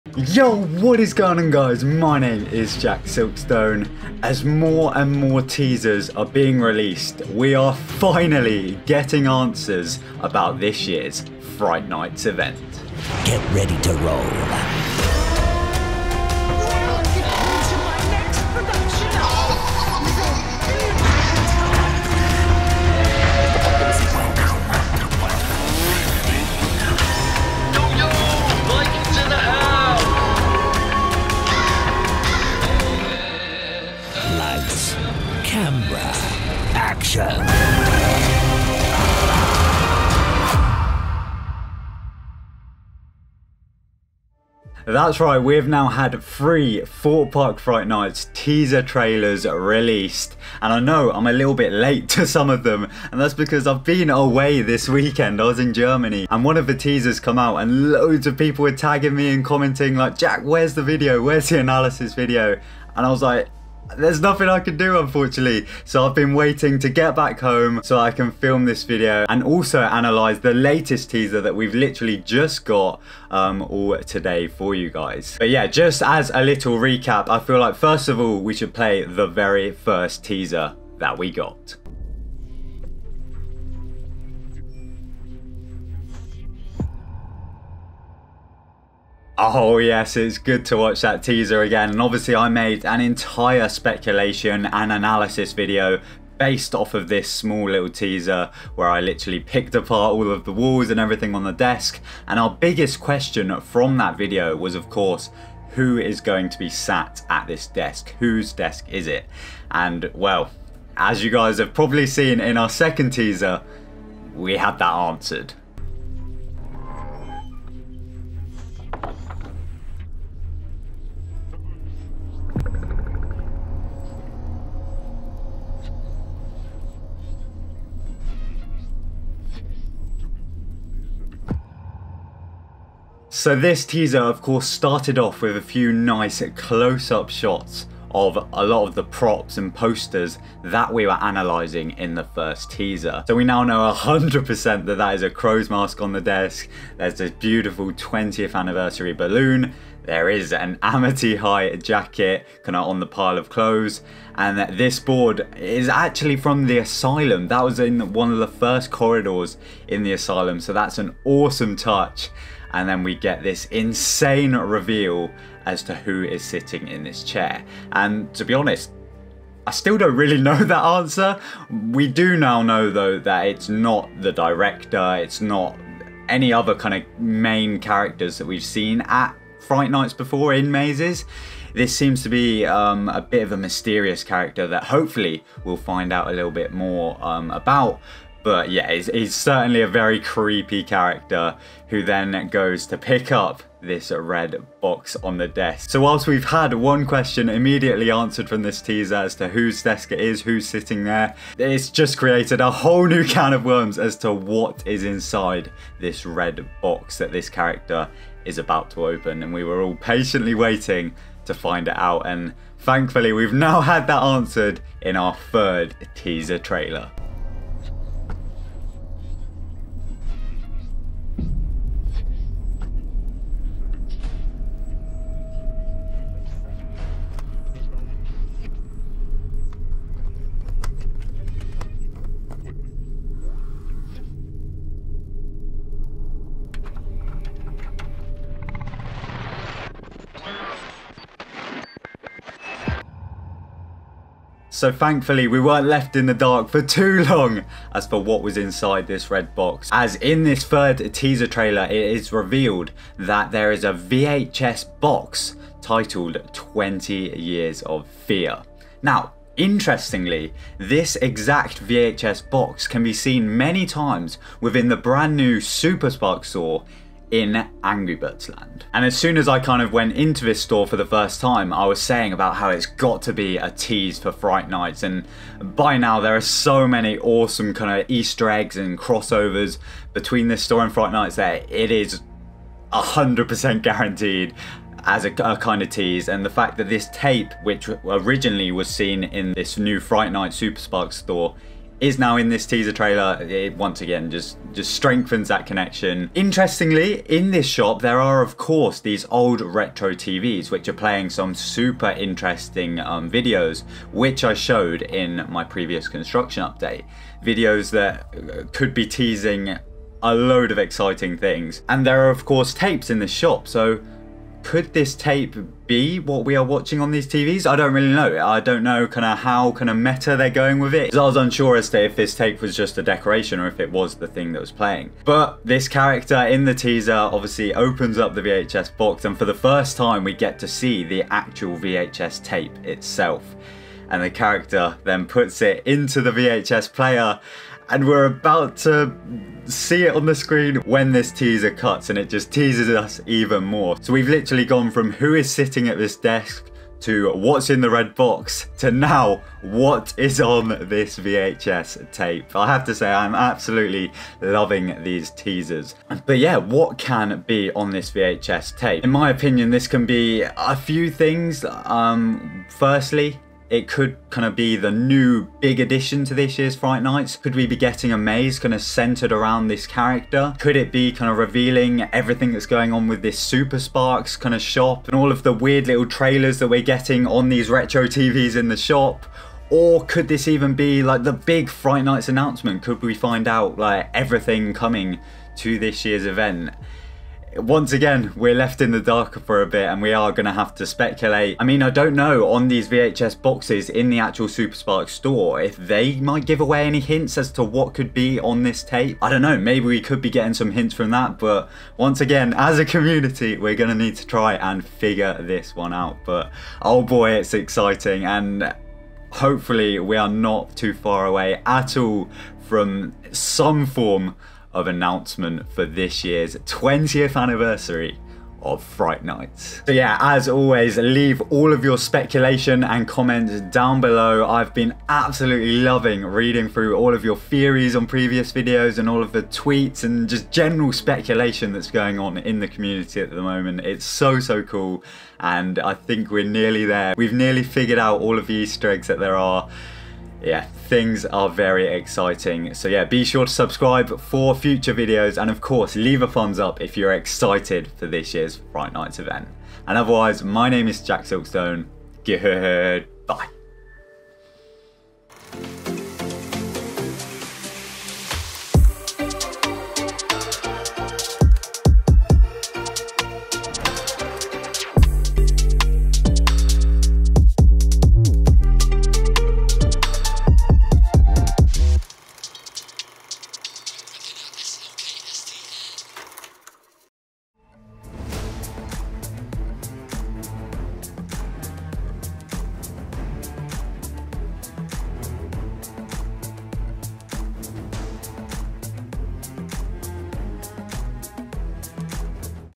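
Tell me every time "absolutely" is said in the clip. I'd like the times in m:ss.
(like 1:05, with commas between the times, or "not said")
5:53, 7:05.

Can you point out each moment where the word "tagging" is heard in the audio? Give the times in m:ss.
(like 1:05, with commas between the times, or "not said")
0:58.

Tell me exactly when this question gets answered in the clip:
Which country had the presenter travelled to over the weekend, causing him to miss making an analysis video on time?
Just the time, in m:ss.
0:55.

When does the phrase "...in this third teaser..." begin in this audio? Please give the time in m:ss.
4:10.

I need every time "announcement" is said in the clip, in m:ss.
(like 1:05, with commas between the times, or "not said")
6:22, 6:54.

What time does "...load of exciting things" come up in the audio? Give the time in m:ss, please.
5:10.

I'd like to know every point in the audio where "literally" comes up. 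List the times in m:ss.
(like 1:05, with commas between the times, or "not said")
1:11, 1:39, 5:44.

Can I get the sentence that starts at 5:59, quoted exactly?
In my opinion, this can be a few things.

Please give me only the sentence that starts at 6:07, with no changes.
Could we be getting a maze kind of centered around this character?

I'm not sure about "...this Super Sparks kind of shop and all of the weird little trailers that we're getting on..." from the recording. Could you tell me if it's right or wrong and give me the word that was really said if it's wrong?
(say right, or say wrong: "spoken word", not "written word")
right.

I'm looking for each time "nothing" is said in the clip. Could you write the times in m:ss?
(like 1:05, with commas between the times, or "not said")
1:04.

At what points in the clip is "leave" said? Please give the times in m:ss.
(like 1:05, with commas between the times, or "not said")
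7:00, 7:25.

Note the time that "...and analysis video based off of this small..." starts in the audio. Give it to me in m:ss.
1:34.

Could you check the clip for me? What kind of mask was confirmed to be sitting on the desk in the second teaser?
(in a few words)
A crow's mask.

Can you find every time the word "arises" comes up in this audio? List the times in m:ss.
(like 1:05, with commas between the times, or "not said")
not said.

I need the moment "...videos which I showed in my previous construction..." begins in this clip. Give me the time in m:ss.
5:03.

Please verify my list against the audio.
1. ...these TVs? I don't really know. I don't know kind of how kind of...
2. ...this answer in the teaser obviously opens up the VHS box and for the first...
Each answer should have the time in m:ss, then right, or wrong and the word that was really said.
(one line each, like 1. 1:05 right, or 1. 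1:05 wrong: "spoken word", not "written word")
1. 5:17 right
2. 5:25 wrong: "character", not "answer".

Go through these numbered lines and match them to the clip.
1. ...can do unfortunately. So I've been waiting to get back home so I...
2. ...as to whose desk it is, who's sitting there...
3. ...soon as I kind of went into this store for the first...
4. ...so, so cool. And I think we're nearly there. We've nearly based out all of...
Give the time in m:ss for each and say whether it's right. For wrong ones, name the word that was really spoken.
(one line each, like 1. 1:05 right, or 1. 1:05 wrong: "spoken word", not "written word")
1. 1:04 right
2. 3:19 right
3. 4:29 right
4. 7:14 wrong: "figured", not "based".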